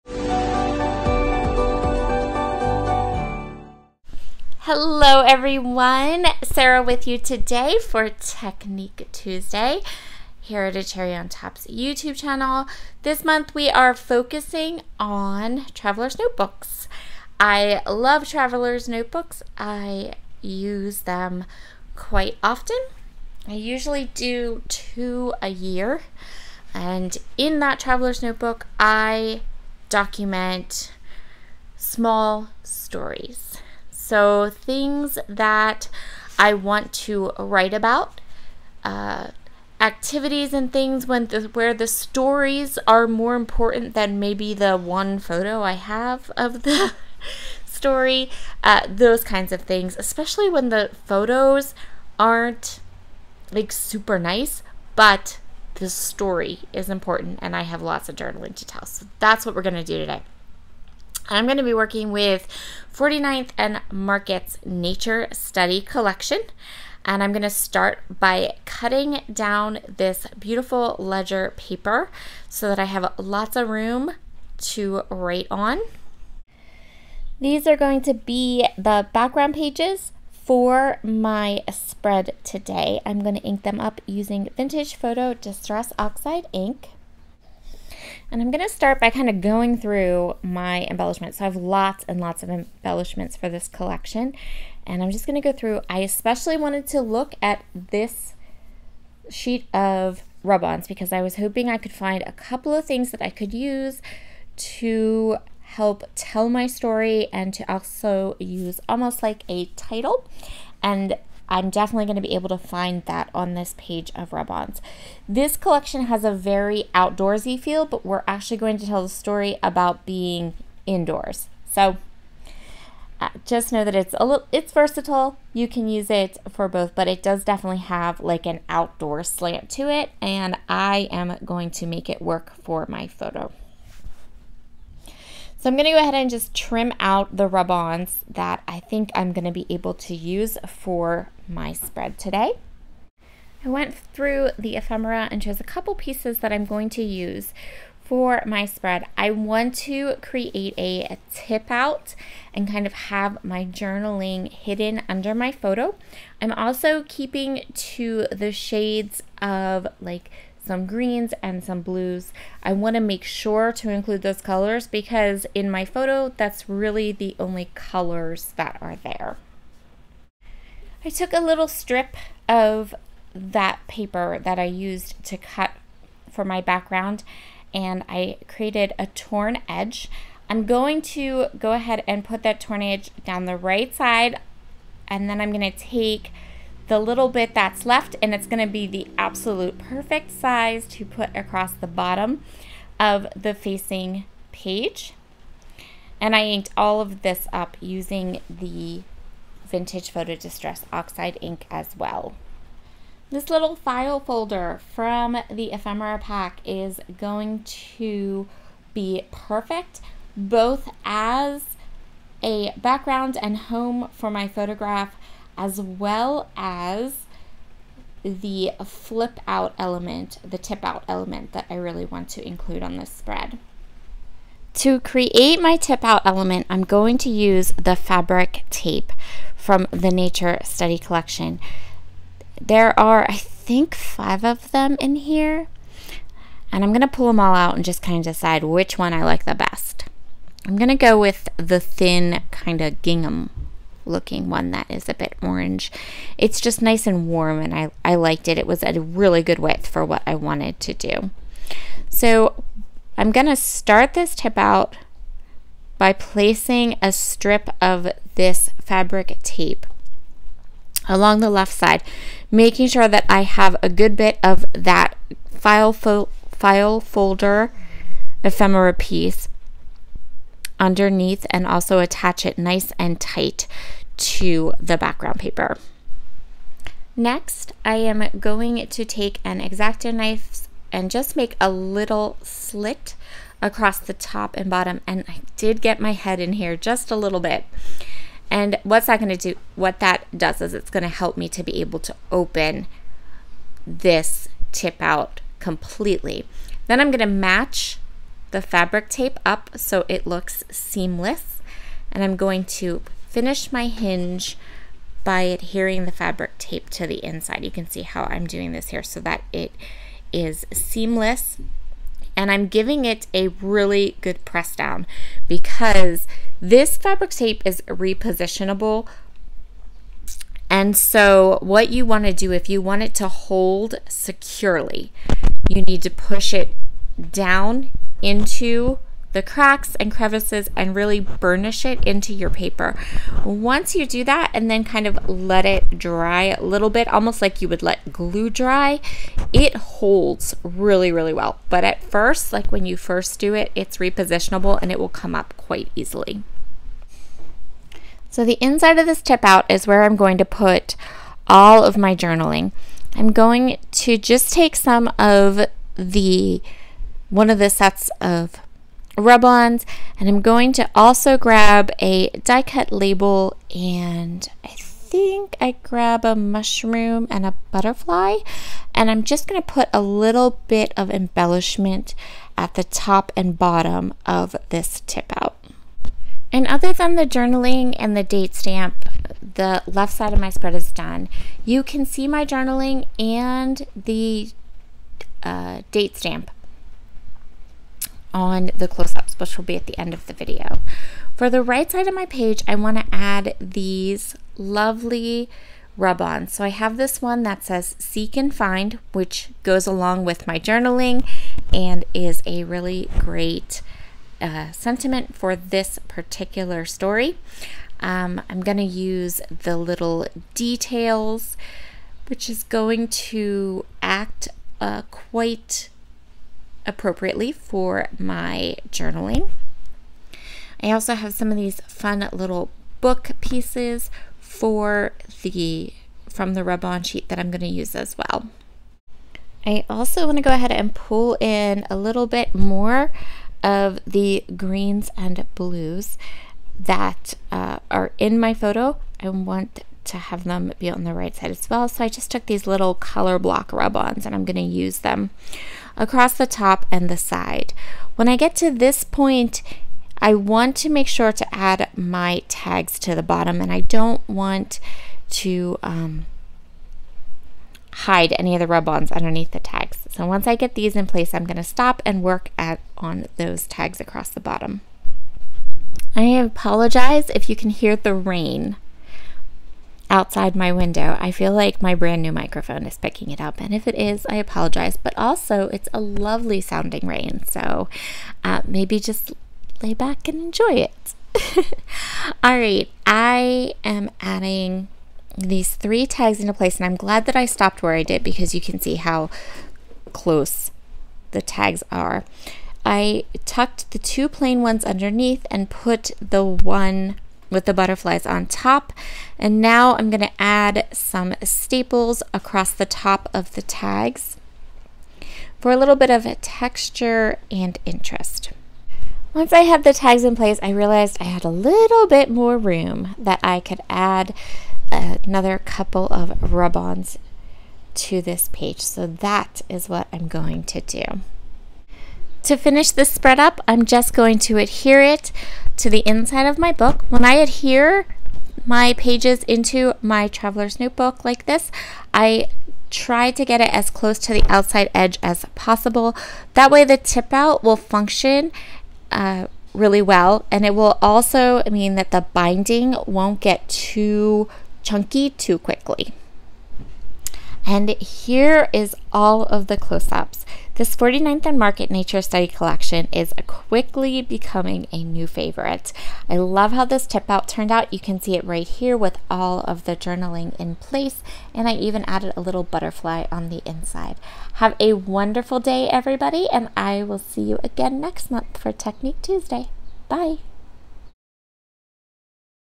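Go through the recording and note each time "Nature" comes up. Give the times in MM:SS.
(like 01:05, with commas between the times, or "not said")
01:04, 03:50, 09:11.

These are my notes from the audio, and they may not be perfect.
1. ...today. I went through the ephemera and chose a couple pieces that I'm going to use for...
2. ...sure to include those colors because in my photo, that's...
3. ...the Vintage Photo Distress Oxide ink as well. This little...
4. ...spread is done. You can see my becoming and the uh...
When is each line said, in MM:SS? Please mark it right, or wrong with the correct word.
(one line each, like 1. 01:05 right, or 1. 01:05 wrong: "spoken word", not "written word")
1. 02:22 right
2. 02:43 right
3. 03:18 right
4. 06:20 wrong: "journaling", not "becoming".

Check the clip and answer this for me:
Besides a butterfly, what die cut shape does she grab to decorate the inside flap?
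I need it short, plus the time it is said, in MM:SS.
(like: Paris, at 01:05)
mushroom, at 06:06.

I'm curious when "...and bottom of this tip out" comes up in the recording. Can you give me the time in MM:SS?
06:13.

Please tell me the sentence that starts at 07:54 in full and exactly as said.
But also, it's a lovely sounding rain, so uh, maybe just lay back and enjoy it.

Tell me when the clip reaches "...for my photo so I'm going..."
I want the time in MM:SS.
02:12.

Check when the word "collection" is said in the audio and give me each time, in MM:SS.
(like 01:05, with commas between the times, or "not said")
01:05, 01:33, 01:55, 03:50, 09:12.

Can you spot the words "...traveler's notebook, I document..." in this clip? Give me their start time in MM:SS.
00:27.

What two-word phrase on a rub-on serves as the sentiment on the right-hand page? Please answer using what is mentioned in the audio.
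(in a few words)
Seek and Find.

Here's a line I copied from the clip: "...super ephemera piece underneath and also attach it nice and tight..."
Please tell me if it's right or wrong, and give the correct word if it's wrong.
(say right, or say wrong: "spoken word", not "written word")
wrong: "folder", not "super".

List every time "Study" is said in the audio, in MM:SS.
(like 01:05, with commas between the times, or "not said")
01:05, 03:50, 09:12.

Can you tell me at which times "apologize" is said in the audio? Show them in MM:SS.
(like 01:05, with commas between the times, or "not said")
07:46, 07:54.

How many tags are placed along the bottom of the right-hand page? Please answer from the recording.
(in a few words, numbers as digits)
3.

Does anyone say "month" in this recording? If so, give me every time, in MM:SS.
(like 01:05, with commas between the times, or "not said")
00:13, 09:28.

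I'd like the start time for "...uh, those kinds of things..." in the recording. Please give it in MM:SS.
00:48.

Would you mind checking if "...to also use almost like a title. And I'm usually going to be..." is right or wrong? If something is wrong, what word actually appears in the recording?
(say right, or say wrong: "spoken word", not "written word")
wrong: "definitely", not "usually".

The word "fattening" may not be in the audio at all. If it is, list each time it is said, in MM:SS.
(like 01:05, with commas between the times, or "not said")
not said.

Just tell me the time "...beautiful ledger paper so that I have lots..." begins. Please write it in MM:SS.
01:10.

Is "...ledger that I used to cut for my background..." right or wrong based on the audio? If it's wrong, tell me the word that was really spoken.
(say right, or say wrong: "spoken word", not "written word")
wrong: "paper", not "ledger".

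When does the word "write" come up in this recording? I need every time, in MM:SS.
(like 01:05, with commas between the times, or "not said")
00:37, 01:15.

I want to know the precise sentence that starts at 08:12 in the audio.
I tucked the two plain ones underneath and put the one with the butterflies on top.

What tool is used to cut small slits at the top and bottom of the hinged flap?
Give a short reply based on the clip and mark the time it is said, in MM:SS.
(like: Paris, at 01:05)
X-Acto knife, at 04:39.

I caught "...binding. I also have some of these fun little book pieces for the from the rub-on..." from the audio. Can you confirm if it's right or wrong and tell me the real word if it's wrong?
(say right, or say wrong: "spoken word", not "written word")
wrong: "journaling", not "binding".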